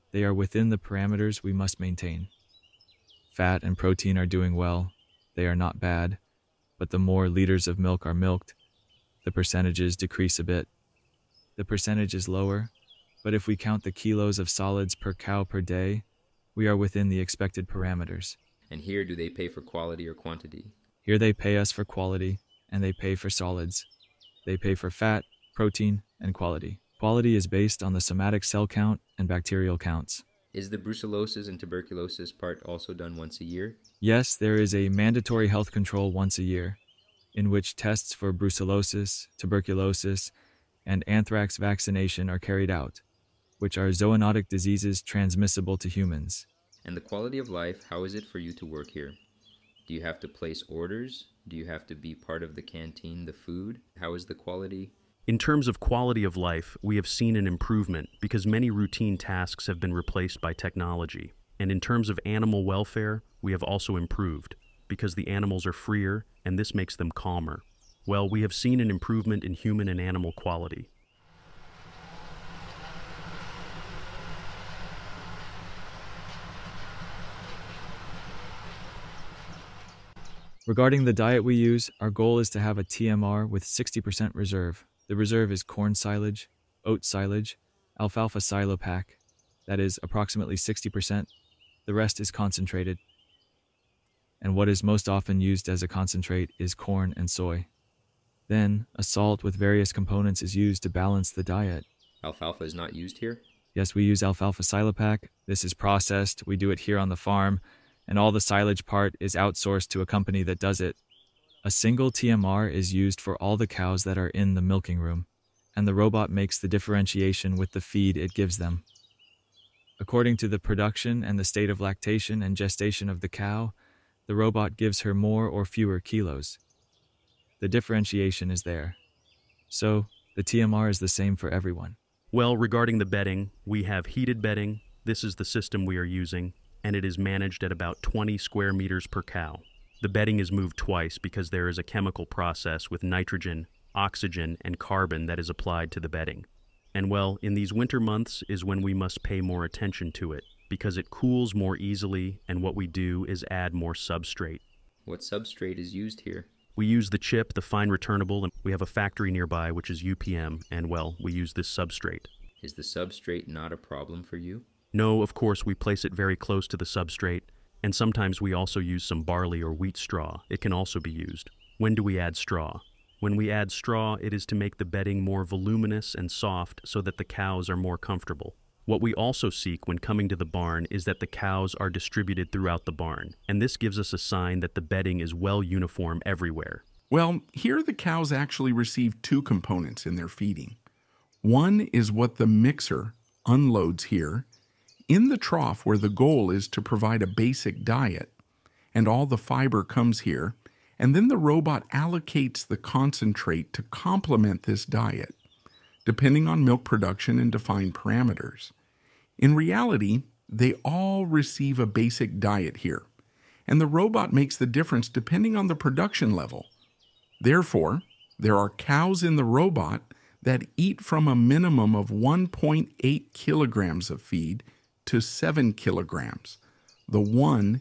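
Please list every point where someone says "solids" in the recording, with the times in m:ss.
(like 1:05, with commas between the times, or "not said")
0:14, 0:23.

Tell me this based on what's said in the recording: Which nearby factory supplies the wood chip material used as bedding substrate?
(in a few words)
UPM.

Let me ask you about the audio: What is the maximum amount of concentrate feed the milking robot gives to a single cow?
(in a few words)
7 kilograms.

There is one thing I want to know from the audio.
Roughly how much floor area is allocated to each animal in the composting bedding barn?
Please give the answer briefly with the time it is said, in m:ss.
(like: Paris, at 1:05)
20 square meters, at 2:18.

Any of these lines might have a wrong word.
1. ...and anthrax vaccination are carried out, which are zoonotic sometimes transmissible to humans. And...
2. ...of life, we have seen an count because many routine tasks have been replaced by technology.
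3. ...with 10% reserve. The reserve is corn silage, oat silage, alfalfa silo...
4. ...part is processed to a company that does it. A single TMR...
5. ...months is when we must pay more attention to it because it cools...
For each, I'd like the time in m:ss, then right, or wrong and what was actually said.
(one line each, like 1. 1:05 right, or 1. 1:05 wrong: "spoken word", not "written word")
1. 0:40 wrong: "diseases", not "sometimes"
2. 0:56 wrong: "improvement", not "count"
3. 1:23 wrong: "60", not "10"
4. 1:48 wrong: "outsourced", not "processed"
5. 2:27 right.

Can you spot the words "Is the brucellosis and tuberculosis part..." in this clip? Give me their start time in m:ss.
0:30.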